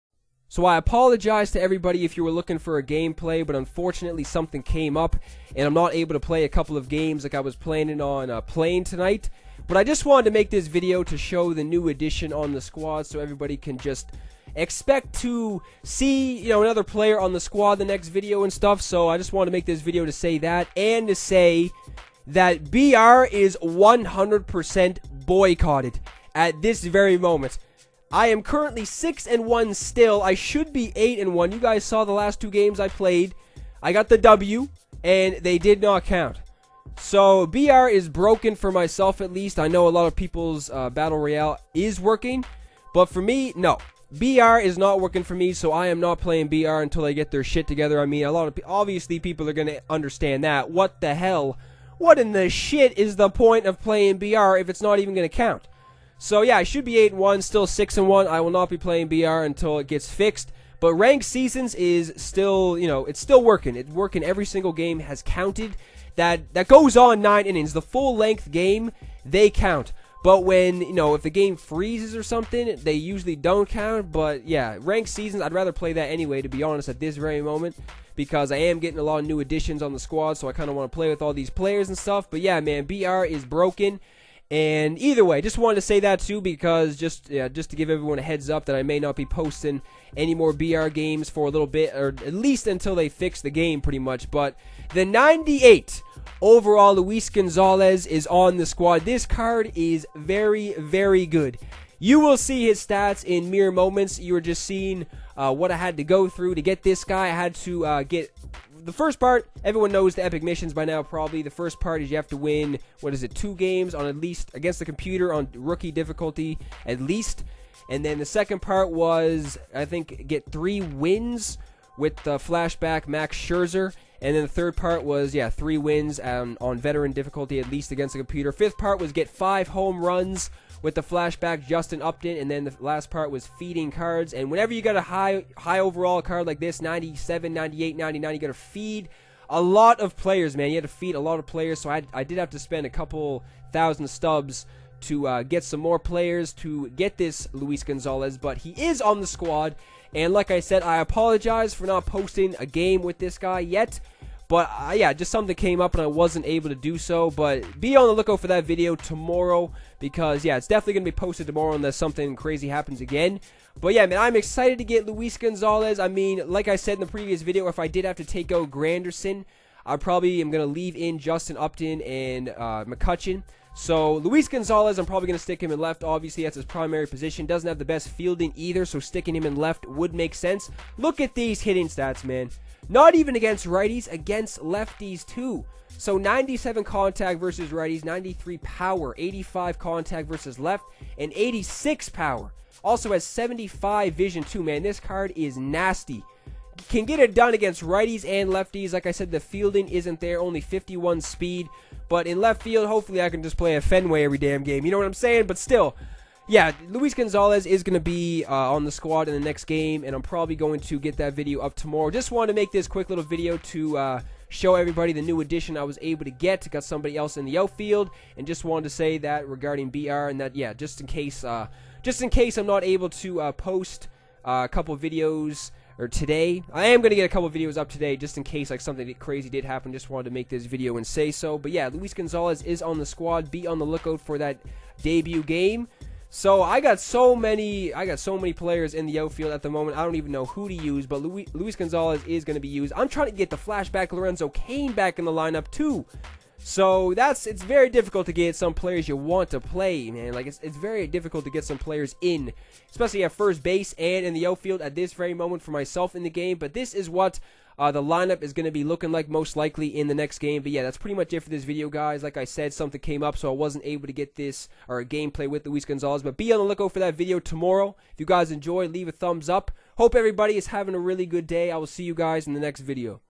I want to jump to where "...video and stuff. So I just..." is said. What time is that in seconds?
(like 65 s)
18 s.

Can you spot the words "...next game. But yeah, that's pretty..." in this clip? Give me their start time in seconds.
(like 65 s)
260 s.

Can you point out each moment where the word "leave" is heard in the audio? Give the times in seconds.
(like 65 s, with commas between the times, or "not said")
170 s, 268 s.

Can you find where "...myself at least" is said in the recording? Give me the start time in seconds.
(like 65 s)
38 s.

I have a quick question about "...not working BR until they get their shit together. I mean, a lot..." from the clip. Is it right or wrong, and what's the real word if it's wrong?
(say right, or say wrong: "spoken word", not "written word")
wrong: "playing", not "working".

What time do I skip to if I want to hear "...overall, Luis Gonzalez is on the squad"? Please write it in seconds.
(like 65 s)
96 s.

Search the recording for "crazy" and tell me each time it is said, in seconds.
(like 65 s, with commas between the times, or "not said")
162 s, 229 s.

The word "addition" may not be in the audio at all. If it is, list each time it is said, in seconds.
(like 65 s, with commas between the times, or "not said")
11 s, 79 s, 215 s.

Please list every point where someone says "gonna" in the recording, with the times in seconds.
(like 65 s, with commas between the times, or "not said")
49 s, 55 s, 160 s, 170 s.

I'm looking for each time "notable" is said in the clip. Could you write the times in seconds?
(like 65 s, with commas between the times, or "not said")
not said.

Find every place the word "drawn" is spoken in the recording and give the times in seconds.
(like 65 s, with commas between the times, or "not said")
not said.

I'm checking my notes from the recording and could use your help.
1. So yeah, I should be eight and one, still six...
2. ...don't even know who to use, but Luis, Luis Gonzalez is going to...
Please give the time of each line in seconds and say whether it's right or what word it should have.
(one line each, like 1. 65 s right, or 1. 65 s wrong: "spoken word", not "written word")
1. 56 s right
2. 240 s right.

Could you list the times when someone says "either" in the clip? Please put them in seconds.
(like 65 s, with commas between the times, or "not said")
84 s, 178 s.